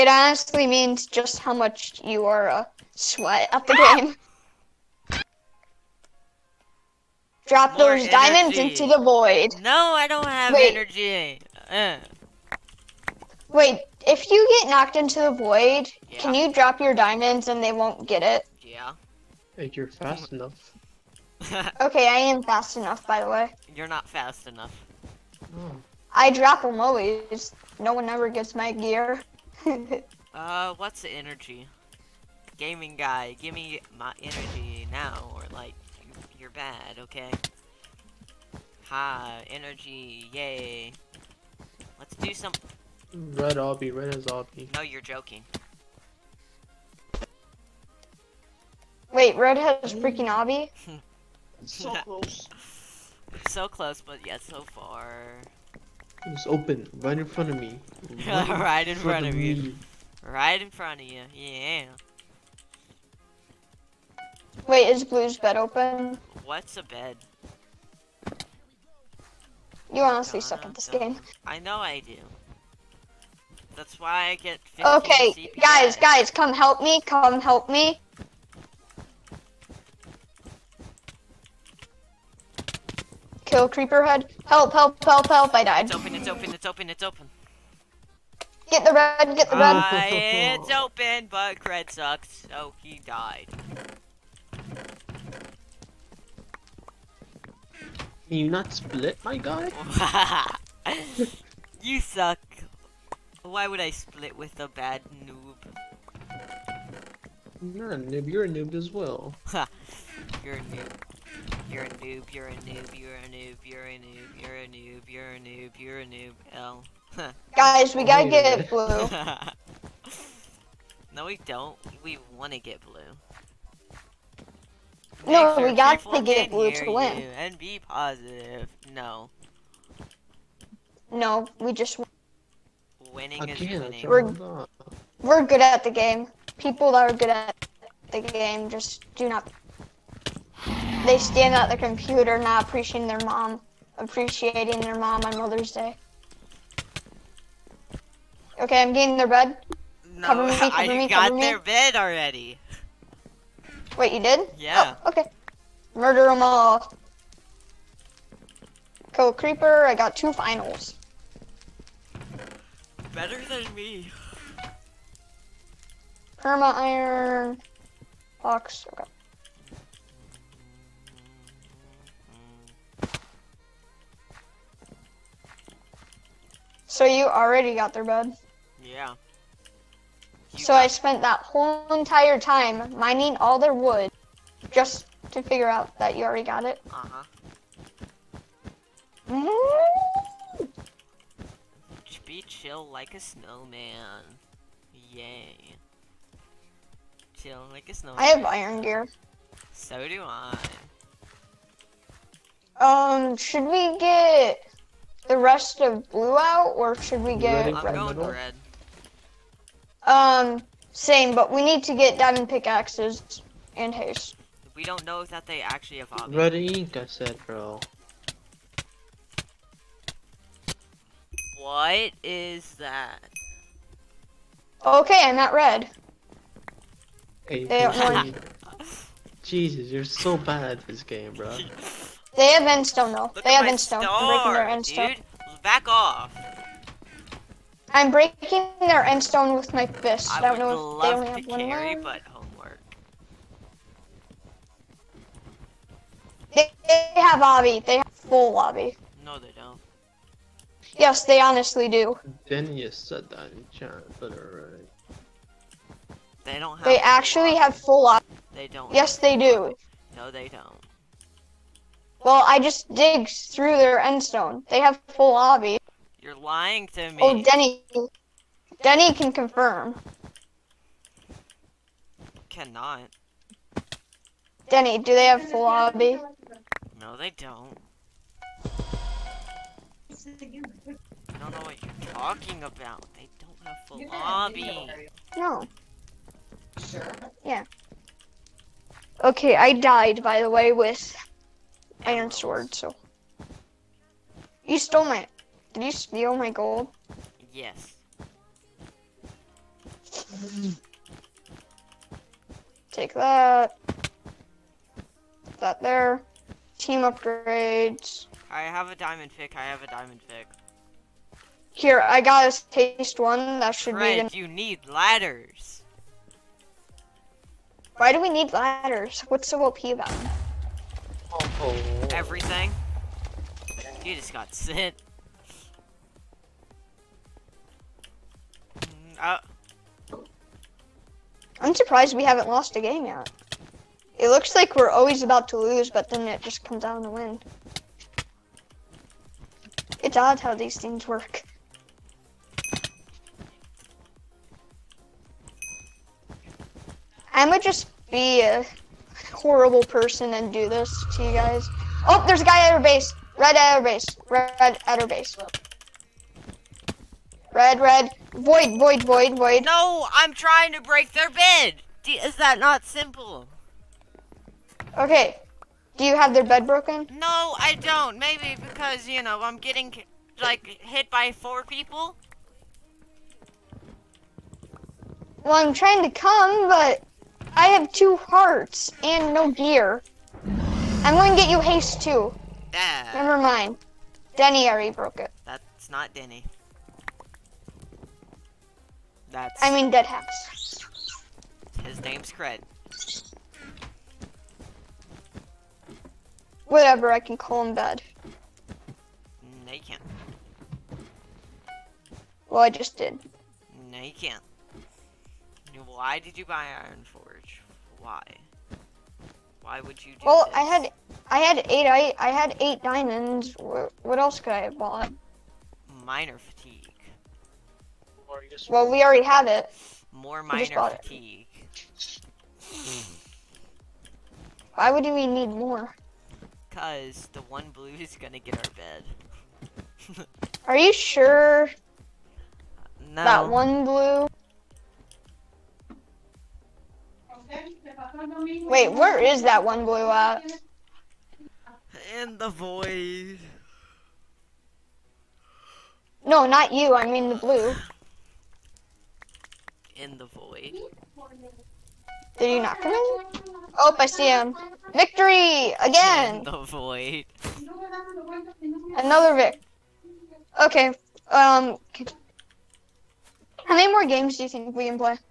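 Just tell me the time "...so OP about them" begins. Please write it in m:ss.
5:19.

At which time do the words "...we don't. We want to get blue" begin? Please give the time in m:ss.
2:01.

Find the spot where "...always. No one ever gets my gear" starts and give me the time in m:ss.
0:26.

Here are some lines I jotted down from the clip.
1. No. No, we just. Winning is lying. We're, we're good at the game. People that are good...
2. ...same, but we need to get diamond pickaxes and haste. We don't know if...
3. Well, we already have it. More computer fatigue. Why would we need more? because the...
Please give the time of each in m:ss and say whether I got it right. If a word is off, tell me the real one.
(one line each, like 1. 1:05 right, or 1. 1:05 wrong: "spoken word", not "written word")
1. 2:08 wrong: "winning", not "lying"
2. 3:30 right
3. 6:58 wrong: "miner", not "computer".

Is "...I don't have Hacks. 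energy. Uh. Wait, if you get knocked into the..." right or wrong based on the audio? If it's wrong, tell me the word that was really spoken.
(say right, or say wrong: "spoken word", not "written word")
wrong: "Wait", not "Hacks".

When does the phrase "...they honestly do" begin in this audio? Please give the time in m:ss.
4:11.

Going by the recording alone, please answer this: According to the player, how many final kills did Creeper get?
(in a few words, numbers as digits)
2.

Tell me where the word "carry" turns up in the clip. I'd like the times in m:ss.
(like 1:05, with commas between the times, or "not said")
4:01.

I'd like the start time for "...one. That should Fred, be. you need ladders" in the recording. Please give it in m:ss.
5:13.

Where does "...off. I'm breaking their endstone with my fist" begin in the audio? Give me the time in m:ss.
3:55.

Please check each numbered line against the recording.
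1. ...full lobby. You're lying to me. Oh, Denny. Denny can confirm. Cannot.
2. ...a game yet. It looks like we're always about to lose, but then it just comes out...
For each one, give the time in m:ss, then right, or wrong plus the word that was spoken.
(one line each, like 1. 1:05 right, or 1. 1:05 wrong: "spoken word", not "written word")
1. 4:25 right
2. 5:32 right.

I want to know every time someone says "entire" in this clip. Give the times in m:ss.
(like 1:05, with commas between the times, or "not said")
3:01.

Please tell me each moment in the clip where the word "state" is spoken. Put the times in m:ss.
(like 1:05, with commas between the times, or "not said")
not said.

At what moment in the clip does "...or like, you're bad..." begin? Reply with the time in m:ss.
0:35.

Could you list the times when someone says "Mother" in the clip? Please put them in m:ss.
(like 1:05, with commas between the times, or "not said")
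2:25.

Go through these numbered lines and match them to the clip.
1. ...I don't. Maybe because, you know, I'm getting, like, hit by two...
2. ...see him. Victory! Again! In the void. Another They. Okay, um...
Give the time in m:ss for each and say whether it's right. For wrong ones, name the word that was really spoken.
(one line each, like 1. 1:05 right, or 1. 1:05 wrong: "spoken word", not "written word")
1. 6:07 wrong: "four", not "two"
2. 7:34 wrong: "Vic", not "They".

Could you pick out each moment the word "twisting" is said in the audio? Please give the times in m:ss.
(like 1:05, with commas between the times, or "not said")
not said.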